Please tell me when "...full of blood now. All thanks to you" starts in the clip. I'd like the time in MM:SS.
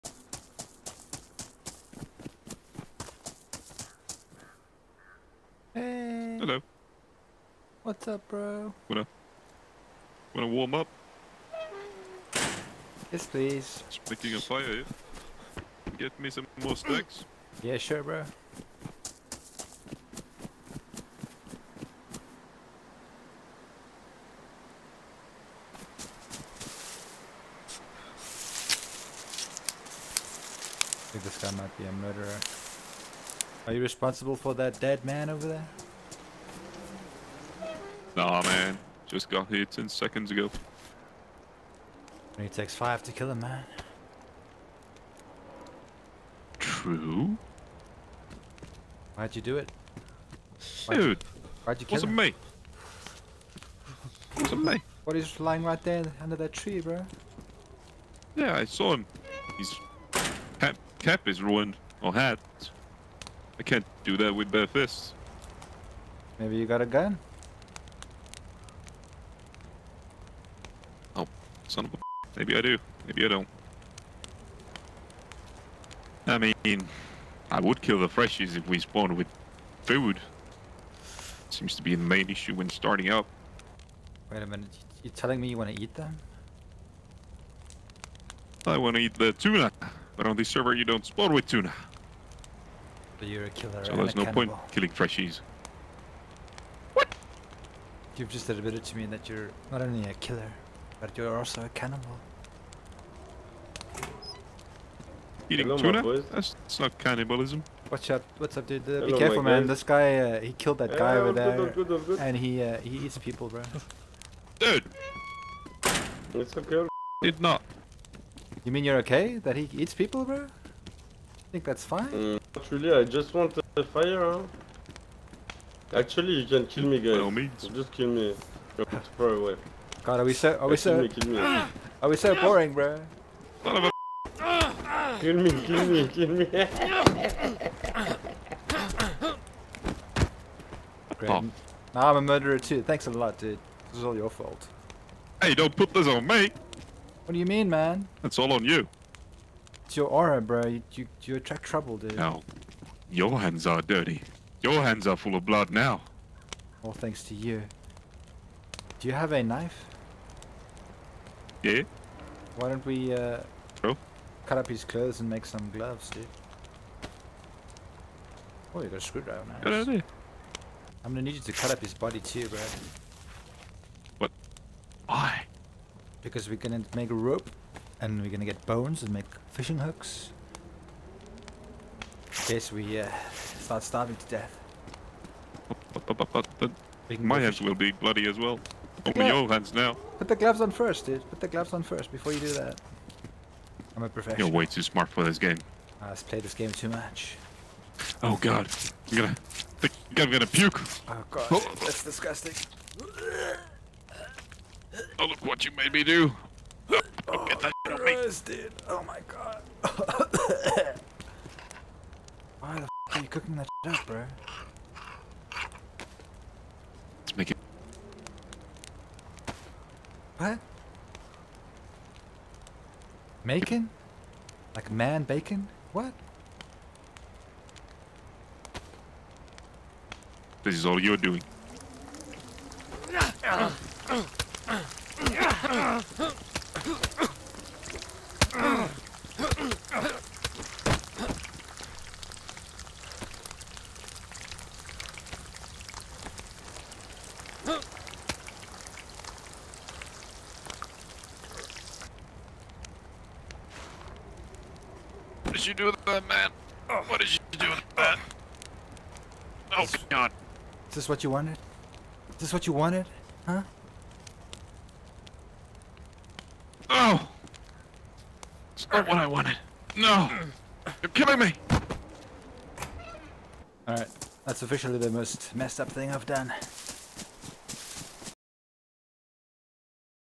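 02:35.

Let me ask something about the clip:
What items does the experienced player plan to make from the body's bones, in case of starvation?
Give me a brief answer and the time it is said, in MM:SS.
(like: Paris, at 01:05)
fishing hooks, at 02:59.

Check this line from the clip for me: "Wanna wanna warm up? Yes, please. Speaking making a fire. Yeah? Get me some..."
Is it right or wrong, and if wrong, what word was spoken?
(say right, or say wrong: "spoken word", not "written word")
right.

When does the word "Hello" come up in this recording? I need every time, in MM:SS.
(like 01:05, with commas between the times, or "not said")
00:06, 01:45.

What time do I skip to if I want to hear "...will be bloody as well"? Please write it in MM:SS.
03:07.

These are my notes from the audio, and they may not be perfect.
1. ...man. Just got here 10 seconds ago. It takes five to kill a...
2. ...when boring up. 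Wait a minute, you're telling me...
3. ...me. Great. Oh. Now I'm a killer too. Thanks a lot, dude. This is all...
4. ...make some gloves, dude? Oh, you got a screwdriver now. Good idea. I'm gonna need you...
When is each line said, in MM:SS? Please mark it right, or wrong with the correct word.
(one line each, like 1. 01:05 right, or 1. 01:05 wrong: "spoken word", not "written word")
1. 00:38 right
2. 01:22 wrong: "starting", not "boring"
3. 02:16 wrong: "murderer", not "killer"
4. 02:45 right.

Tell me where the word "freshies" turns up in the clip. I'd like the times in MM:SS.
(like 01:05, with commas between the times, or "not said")
01:18, 01:34.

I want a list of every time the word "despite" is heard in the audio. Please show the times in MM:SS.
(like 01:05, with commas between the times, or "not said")
not said.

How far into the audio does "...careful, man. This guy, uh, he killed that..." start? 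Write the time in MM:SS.
01:49.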